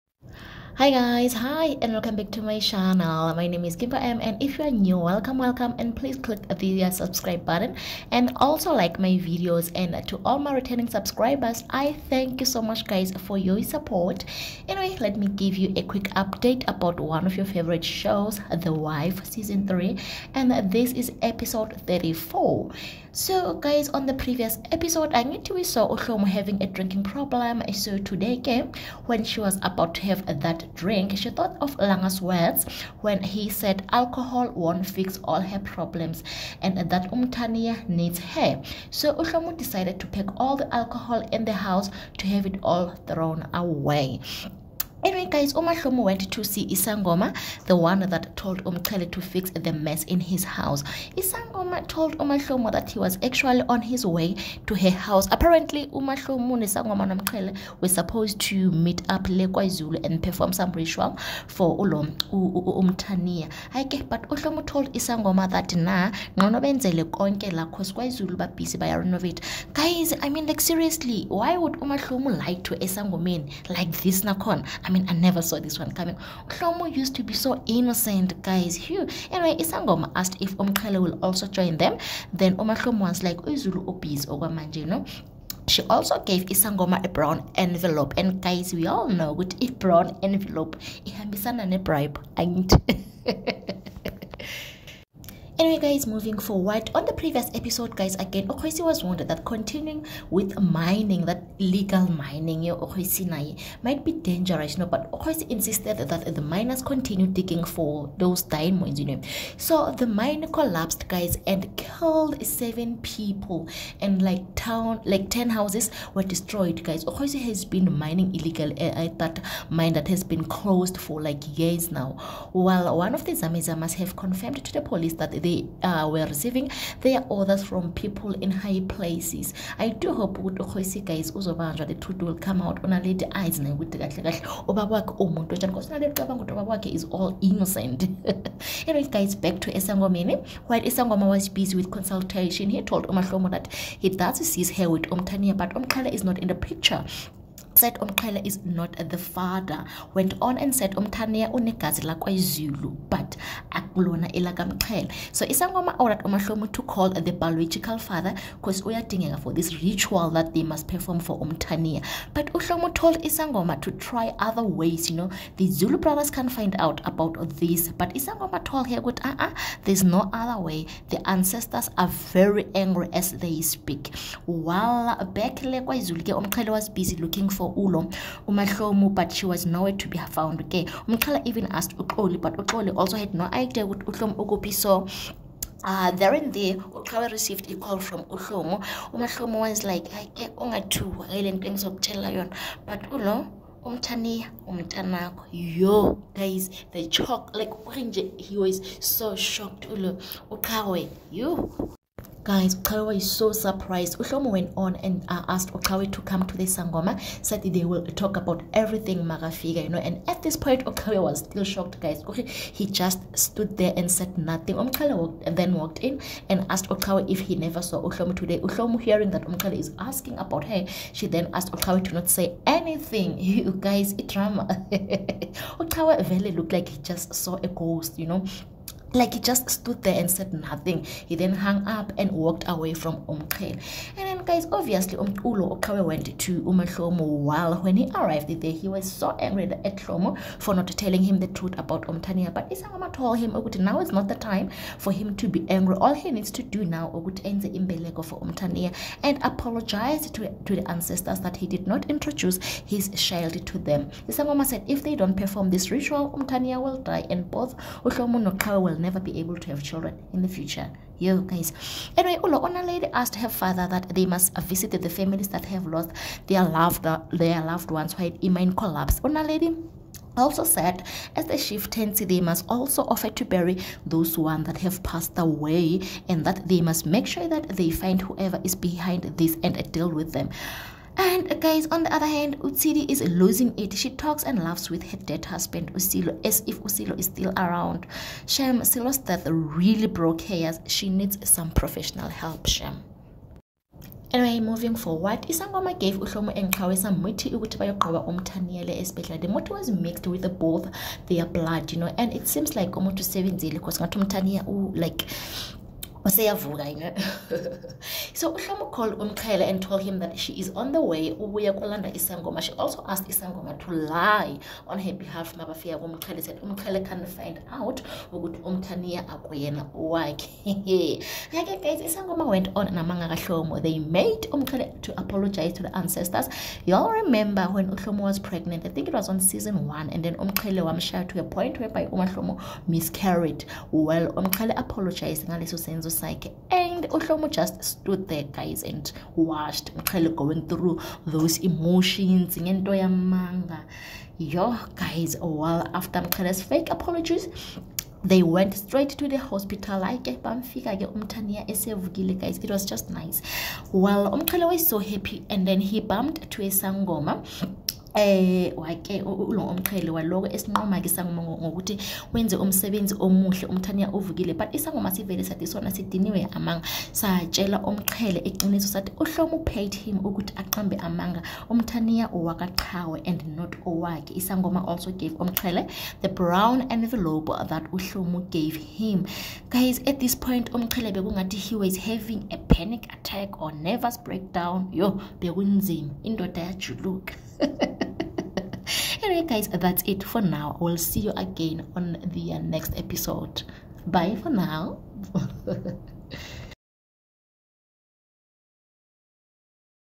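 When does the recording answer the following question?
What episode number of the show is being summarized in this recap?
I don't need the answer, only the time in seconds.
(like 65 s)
21 s.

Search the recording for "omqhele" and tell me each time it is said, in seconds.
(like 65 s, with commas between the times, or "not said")
233 s, 359 s, 367 s, 375 s, 380 s.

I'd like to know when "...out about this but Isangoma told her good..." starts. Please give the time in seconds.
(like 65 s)
166 s.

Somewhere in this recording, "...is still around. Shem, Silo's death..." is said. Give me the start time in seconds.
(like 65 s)
287 s.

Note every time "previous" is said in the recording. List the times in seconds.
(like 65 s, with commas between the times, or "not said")
24 s, 97 s.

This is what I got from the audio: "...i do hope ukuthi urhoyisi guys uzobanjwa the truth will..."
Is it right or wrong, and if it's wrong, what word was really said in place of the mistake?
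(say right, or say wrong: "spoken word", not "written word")
right.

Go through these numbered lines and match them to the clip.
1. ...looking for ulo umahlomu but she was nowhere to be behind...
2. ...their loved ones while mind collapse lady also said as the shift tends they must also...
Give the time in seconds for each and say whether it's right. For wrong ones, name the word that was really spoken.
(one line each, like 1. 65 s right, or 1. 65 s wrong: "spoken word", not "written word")
1. 177 s wrong: "found", not "behind"
2. 267 s right.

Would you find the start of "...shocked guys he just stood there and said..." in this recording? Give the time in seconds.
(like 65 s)
211 s.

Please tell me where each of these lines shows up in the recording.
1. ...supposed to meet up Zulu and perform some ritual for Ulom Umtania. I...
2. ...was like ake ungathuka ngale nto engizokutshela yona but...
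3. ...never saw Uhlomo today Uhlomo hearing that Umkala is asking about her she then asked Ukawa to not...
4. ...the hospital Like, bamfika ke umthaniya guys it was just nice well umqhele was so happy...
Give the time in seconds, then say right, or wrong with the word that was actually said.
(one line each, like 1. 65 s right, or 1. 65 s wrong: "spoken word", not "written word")
1. 57 s right
2. 189 s right
3. 217 s right
4. 349 s right.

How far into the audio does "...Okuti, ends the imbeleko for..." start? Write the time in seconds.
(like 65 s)
247 s.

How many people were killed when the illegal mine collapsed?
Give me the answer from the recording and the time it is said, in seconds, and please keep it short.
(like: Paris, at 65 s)
7, at 112 s.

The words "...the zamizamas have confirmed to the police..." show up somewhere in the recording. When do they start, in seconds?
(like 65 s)
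123 s.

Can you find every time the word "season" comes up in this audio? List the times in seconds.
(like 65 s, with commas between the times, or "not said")
19 s, 329 s.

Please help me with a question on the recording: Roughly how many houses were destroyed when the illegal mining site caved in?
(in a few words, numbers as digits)
10.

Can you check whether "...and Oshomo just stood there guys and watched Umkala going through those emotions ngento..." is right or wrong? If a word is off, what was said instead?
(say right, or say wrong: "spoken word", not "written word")
wrong: "Mqhele", not "Umkala".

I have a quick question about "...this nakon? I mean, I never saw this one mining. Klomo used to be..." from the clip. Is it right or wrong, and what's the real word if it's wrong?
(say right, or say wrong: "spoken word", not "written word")
wrong: "coming", not "mining".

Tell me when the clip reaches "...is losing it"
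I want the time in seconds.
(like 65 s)
283 s.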